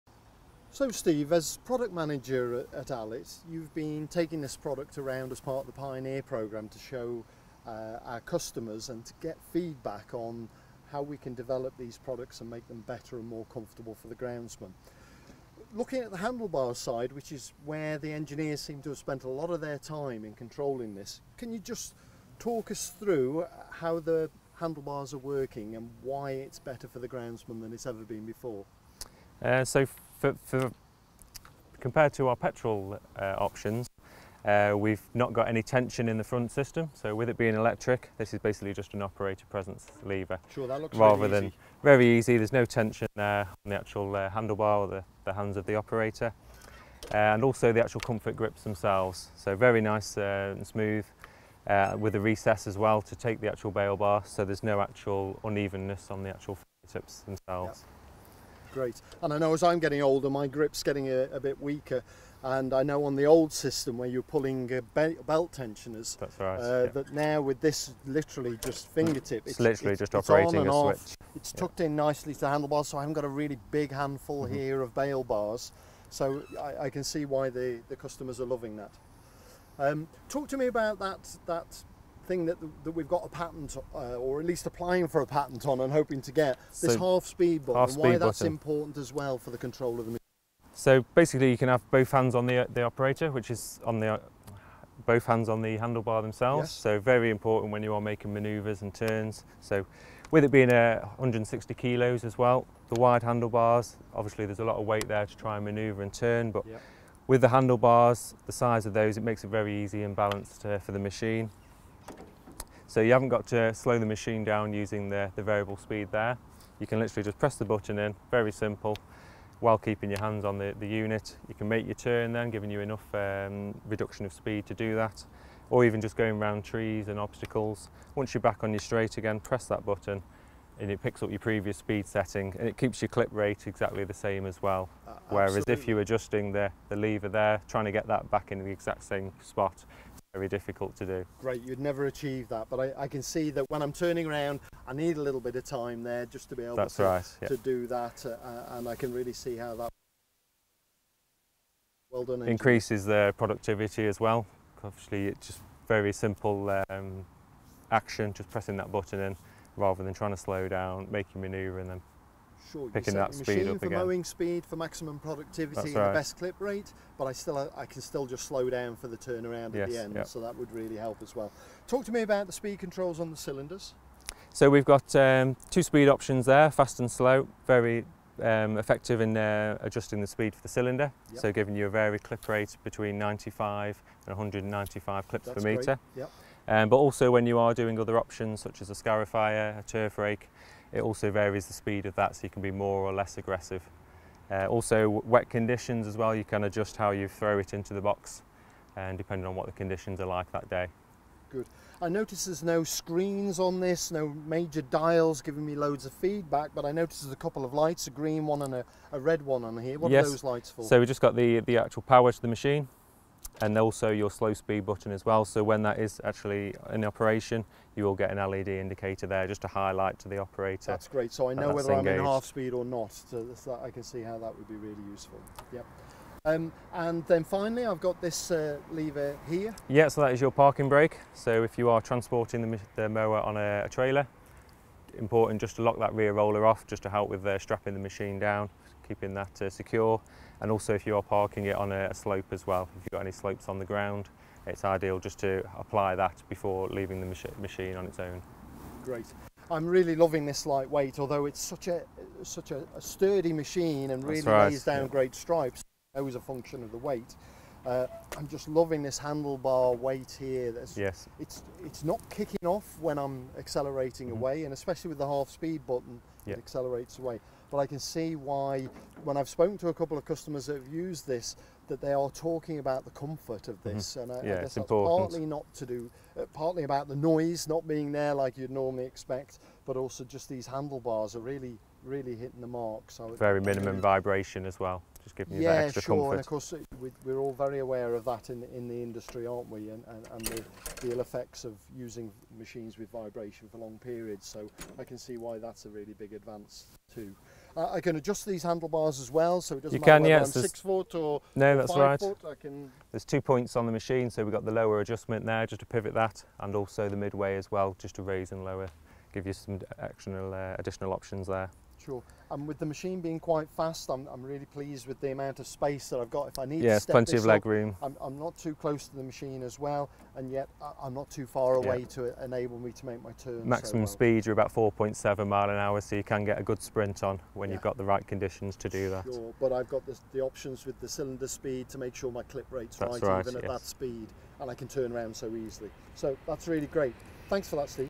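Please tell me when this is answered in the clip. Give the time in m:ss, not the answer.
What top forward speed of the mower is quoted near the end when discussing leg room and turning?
5:24.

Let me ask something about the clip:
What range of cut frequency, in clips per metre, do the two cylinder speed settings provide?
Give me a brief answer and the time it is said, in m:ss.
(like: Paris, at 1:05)
95 to 195, at 3:03.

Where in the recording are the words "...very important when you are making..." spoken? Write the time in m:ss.
1:36.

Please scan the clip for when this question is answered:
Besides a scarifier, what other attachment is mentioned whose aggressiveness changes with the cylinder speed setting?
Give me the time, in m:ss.
3:09.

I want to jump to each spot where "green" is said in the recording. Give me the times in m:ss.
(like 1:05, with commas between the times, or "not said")
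3:28.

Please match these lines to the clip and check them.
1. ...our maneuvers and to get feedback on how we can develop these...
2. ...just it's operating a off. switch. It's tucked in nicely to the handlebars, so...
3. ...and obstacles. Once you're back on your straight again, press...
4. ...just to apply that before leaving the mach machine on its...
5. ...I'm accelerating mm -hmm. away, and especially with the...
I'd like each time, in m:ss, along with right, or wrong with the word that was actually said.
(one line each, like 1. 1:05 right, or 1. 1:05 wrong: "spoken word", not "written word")
1. 0:08 wrong: "customers", not "maneuvers"
2. 1:09 right
3. 2:07 right
4. 4:05 right
5. 4:23 right.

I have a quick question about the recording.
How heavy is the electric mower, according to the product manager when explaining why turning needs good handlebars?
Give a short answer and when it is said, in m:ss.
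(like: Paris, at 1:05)
160 kilos, at 1:41.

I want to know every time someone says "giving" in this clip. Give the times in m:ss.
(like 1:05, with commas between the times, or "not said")
2:02, 3:01, 3:25, 4:45.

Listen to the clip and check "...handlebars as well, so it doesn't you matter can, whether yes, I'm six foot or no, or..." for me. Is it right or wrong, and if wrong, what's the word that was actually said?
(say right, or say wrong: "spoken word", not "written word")
right.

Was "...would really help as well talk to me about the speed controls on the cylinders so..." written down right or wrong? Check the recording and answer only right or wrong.
right.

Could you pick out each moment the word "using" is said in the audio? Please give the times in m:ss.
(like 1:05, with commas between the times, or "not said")
1:54, 4:51.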